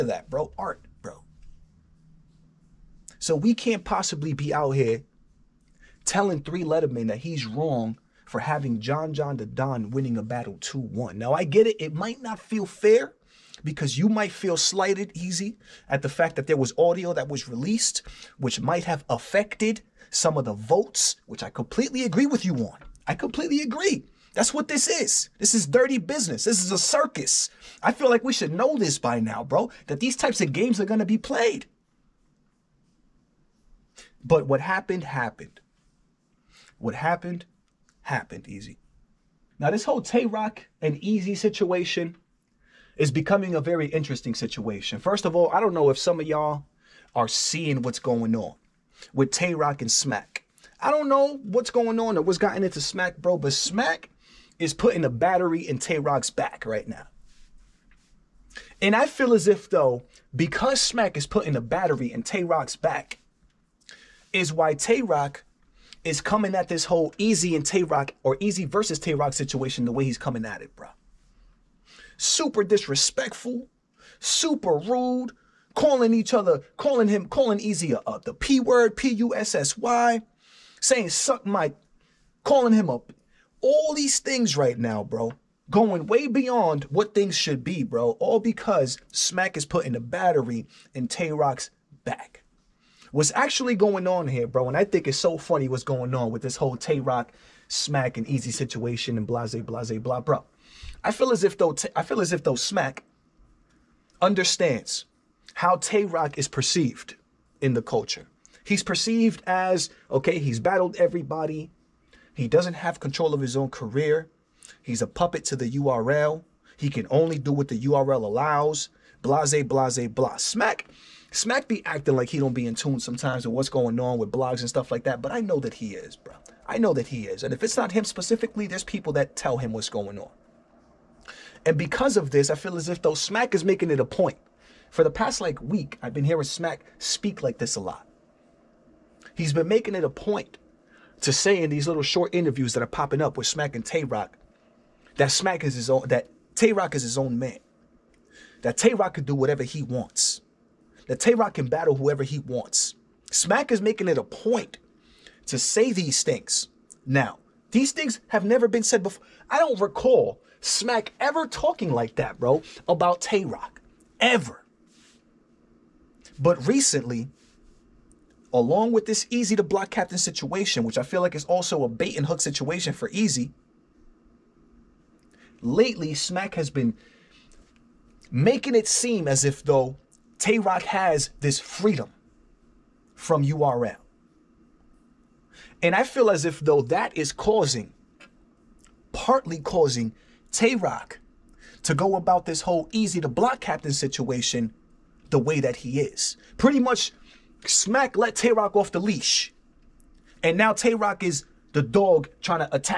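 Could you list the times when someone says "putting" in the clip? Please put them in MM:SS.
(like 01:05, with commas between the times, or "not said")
00:54, 01:01, 01:29.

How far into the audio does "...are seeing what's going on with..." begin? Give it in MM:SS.
00:47.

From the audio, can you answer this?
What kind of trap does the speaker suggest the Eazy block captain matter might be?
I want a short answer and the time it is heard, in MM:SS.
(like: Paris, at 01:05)
bait and hook, at 02:51.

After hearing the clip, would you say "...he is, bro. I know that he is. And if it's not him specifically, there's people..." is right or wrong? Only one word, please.
right.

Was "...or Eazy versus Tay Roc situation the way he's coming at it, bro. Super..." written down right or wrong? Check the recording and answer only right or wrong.
right.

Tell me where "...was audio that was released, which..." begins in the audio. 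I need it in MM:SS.
00:16.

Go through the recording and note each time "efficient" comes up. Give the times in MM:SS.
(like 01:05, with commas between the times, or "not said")
not said.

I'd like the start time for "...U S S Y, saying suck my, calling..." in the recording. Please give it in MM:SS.
01:19.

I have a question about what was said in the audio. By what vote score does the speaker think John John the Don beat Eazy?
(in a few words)
2-1.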